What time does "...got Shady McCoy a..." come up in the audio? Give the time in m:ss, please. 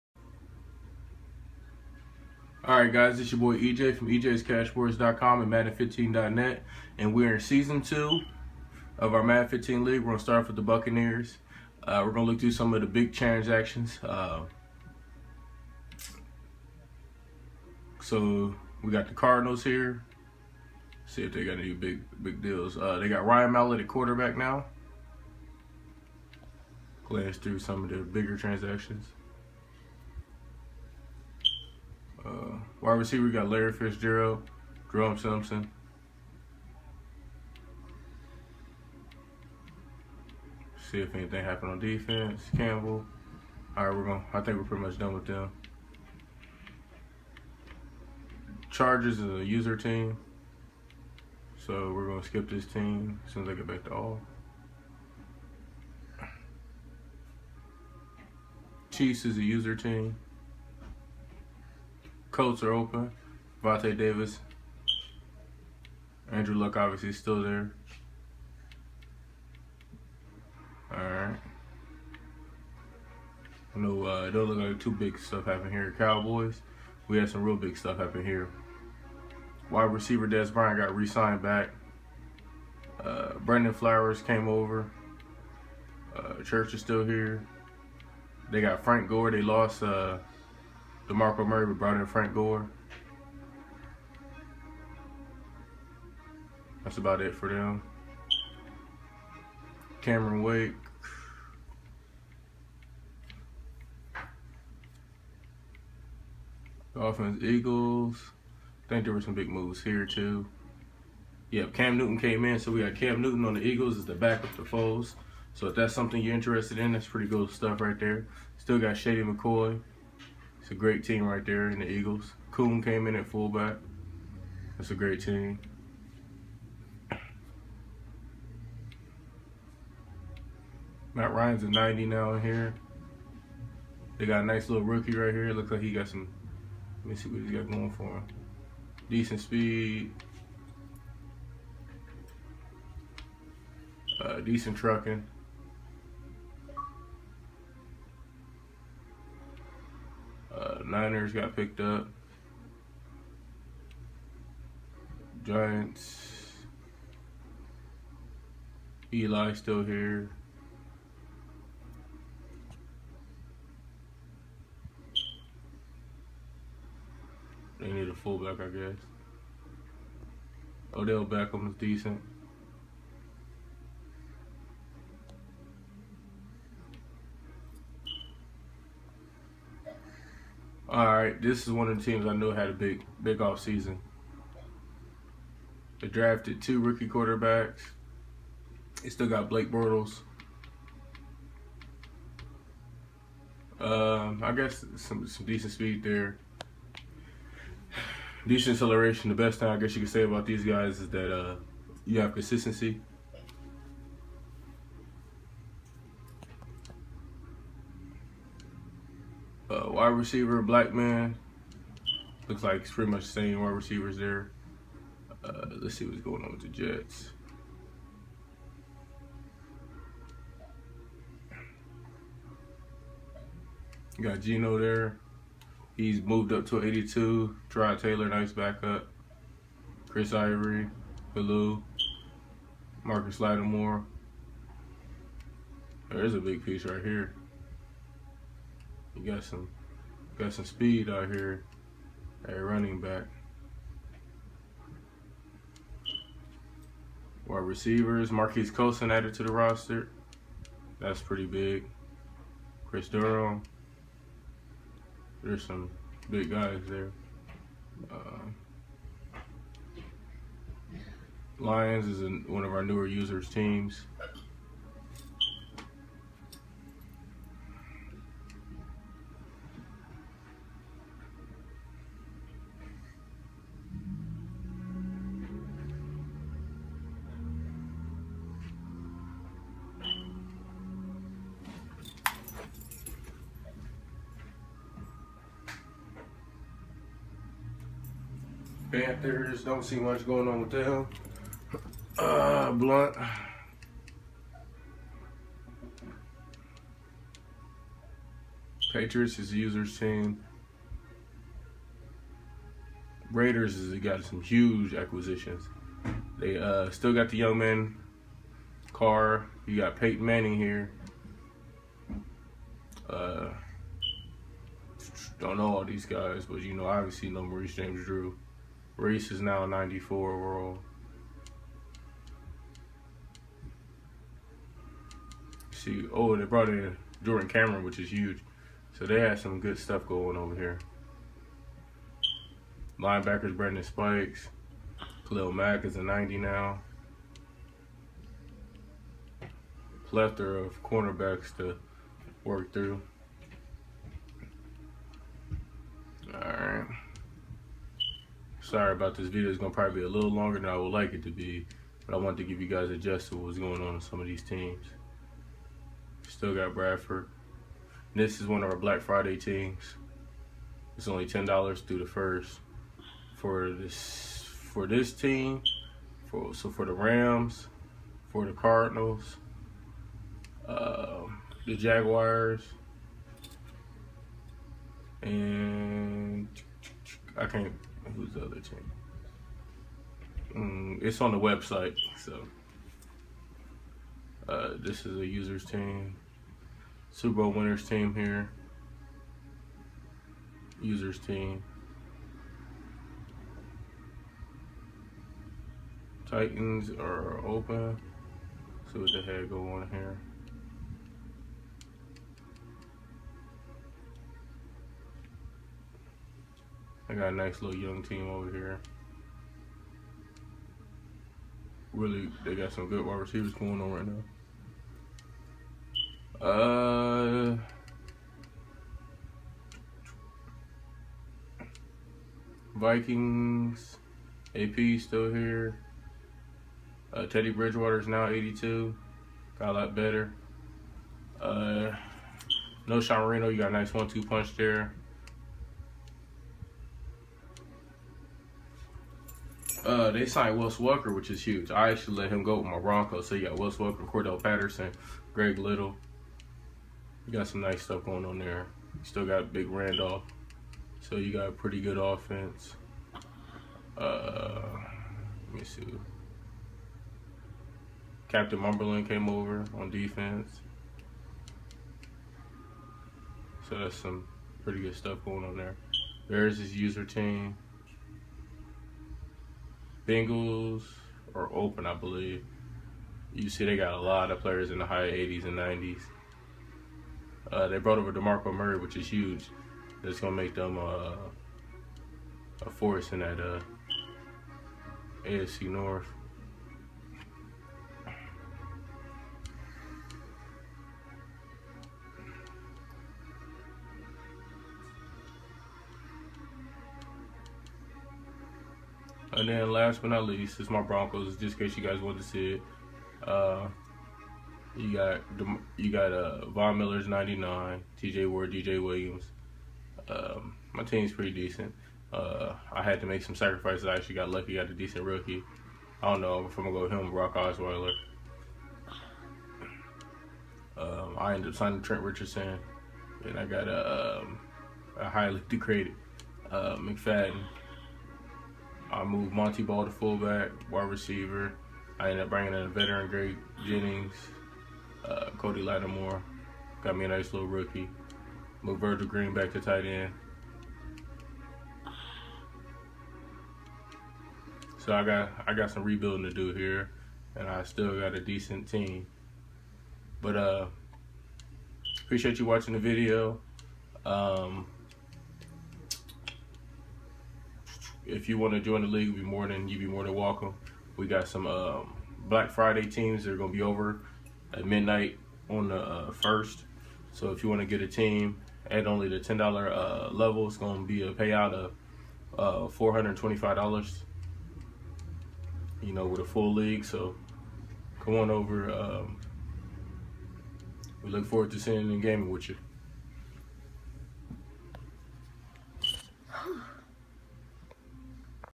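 1:58.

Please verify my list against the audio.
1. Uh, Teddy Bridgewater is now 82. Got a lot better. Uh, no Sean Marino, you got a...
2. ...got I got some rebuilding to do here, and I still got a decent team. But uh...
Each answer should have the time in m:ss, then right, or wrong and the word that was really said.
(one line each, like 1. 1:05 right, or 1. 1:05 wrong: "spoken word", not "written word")
1. 7:07 right
2. 9:05 right.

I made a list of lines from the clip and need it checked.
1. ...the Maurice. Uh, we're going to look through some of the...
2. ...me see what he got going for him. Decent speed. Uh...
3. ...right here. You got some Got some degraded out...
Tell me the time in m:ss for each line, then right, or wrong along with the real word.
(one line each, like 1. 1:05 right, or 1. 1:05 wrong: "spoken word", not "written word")
1. 0:10 wrong: "Buccaneers", not "Maurice"
2. 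2:17 right
3. 3:56 wrong: "speed", not "degraded".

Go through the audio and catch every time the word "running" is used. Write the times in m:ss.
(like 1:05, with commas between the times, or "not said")
4:02.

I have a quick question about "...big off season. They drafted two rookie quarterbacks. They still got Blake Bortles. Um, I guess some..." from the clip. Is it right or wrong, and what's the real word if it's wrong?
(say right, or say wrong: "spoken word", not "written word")
right.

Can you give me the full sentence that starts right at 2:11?
Matt Ryan's a 90 now in here.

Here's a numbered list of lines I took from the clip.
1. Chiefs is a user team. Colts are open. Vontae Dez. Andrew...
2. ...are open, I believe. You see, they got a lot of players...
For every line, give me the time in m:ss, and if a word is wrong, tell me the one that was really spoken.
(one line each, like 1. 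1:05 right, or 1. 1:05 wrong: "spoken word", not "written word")
1. 0:58 wrong: "Davis", not "Dez"
2. 7:51 right.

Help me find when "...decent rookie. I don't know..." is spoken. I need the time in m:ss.
8:34.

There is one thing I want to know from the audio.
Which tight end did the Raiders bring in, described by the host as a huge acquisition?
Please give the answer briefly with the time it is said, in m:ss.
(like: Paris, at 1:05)
Jordan Cameron, at 5:27.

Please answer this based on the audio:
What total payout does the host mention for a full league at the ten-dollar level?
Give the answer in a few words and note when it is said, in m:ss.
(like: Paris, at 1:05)
$425, at 9:32.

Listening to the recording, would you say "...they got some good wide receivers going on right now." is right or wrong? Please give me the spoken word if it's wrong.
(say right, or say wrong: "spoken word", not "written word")
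right.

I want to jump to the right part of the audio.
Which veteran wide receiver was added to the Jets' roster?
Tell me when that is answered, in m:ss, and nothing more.
4:08.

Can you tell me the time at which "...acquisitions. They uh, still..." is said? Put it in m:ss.
5:04.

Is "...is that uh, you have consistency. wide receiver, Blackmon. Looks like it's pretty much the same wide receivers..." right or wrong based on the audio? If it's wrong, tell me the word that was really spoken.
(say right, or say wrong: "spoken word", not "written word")
right.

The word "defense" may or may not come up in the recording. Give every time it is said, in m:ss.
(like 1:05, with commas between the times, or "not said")
0:41, 7:39.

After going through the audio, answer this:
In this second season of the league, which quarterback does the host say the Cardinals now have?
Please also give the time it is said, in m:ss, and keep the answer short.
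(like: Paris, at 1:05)
Ryan Mallett, at 0:23.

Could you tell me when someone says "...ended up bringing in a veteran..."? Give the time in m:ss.
8:52.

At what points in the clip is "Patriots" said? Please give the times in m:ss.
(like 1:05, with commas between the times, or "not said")
4:58.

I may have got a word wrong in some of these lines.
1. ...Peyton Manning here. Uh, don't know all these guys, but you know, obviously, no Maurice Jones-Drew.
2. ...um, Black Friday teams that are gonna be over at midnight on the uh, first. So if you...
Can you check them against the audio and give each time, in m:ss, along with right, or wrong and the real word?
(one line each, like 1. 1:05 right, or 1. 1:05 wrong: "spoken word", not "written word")
1. 5:09 right
2. 9:21 right.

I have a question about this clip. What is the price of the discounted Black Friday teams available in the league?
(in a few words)
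$10.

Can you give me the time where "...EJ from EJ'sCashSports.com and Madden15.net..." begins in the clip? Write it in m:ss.
0:03.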